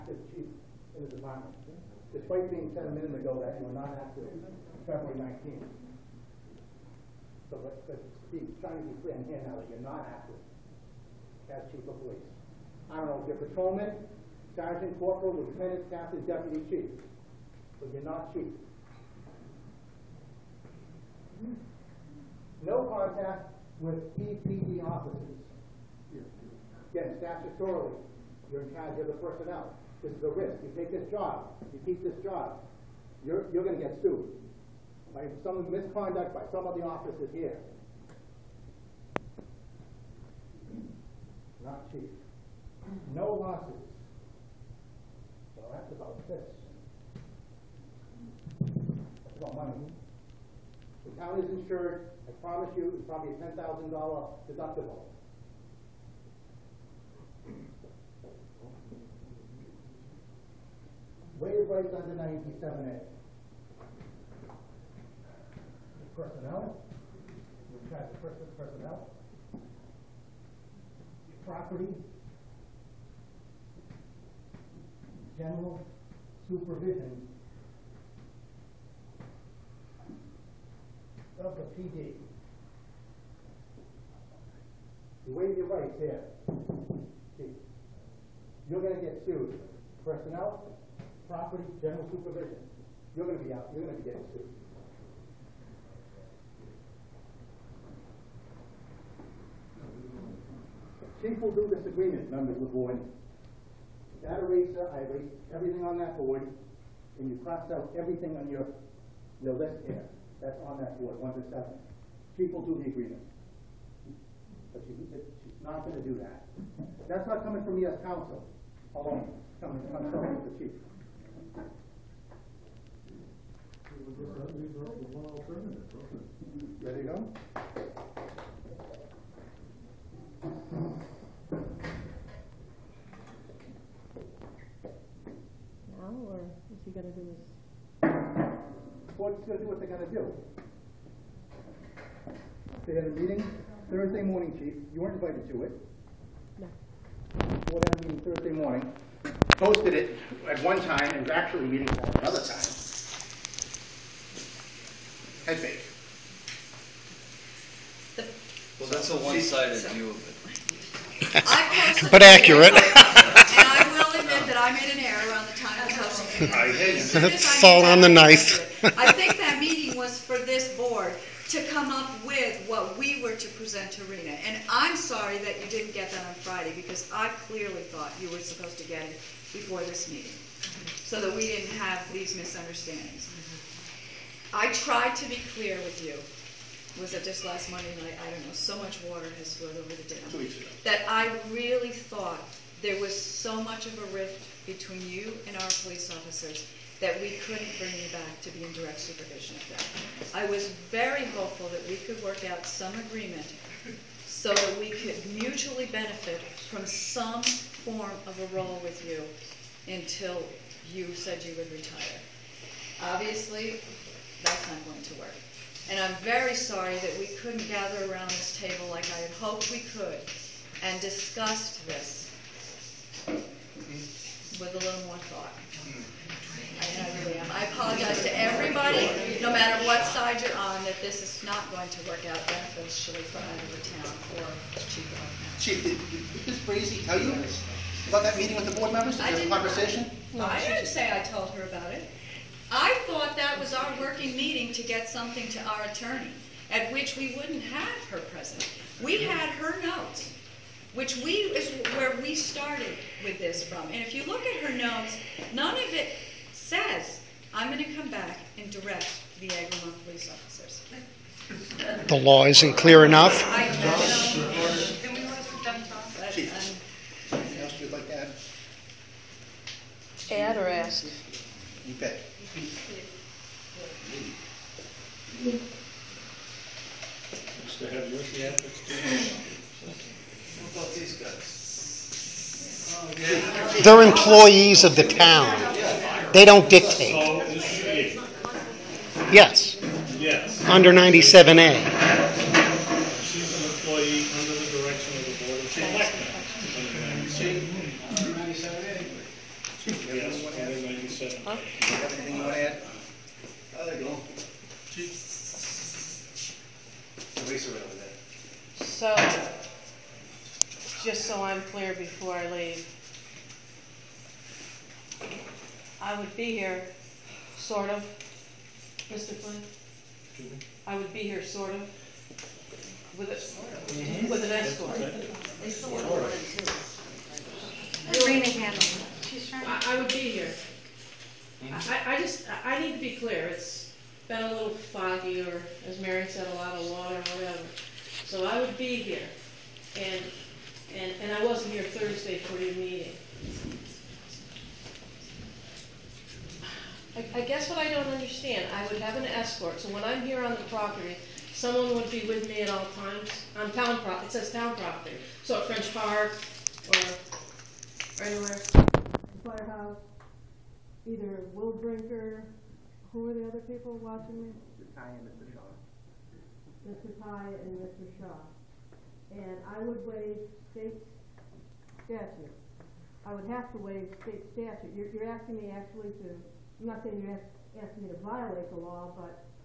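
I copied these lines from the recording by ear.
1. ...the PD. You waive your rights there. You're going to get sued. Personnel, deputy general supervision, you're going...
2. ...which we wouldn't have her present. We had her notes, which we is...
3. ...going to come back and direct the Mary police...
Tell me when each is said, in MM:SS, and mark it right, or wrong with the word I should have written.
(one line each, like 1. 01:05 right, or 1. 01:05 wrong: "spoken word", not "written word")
1. 01:21 wrong: "property", not "deputy"
2. 04:06 right
3. 04:17 wrong: "Agamemnon", not "Mary".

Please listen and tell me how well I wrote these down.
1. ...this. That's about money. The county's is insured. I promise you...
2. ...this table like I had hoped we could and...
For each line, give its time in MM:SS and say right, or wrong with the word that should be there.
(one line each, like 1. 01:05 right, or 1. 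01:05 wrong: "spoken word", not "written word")
1. 00:46 right
2. 03:38 right.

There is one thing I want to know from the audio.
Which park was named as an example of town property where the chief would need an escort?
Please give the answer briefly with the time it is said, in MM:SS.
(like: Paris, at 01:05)
French Park, at 05:55.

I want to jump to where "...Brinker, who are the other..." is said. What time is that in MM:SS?
06:01.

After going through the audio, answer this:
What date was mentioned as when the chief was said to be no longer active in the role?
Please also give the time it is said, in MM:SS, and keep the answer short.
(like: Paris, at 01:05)
February 19, at 00:04.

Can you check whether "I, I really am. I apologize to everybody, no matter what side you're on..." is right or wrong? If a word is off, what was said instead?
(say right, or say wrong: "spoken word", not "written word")
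right.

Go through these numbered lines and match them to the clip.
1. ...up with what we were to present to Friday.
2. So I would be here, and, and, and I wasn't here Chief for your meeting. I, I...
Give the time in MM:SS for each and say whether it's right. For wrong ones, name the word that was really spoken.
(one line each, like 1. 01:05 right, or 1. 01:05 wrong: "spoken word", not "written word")
1. 02:51 wrong: "Rena", not "Friday"
2. 05:38 wrong: "Thursday", not "Chief".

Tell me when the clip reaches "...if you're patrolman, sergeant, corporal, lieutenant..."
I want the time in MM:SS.
00:13.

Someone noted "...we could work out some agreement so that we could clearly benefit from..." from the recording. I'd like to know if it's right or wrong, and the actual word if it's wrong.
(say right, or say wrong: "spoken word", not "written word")
wrong: "mutually", not "clearly".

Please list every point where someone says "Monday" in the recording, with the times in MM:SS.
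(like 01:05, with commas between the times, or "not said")
03:07.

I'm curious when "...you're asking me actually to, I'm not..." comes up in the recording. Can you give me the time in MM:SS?
06:15.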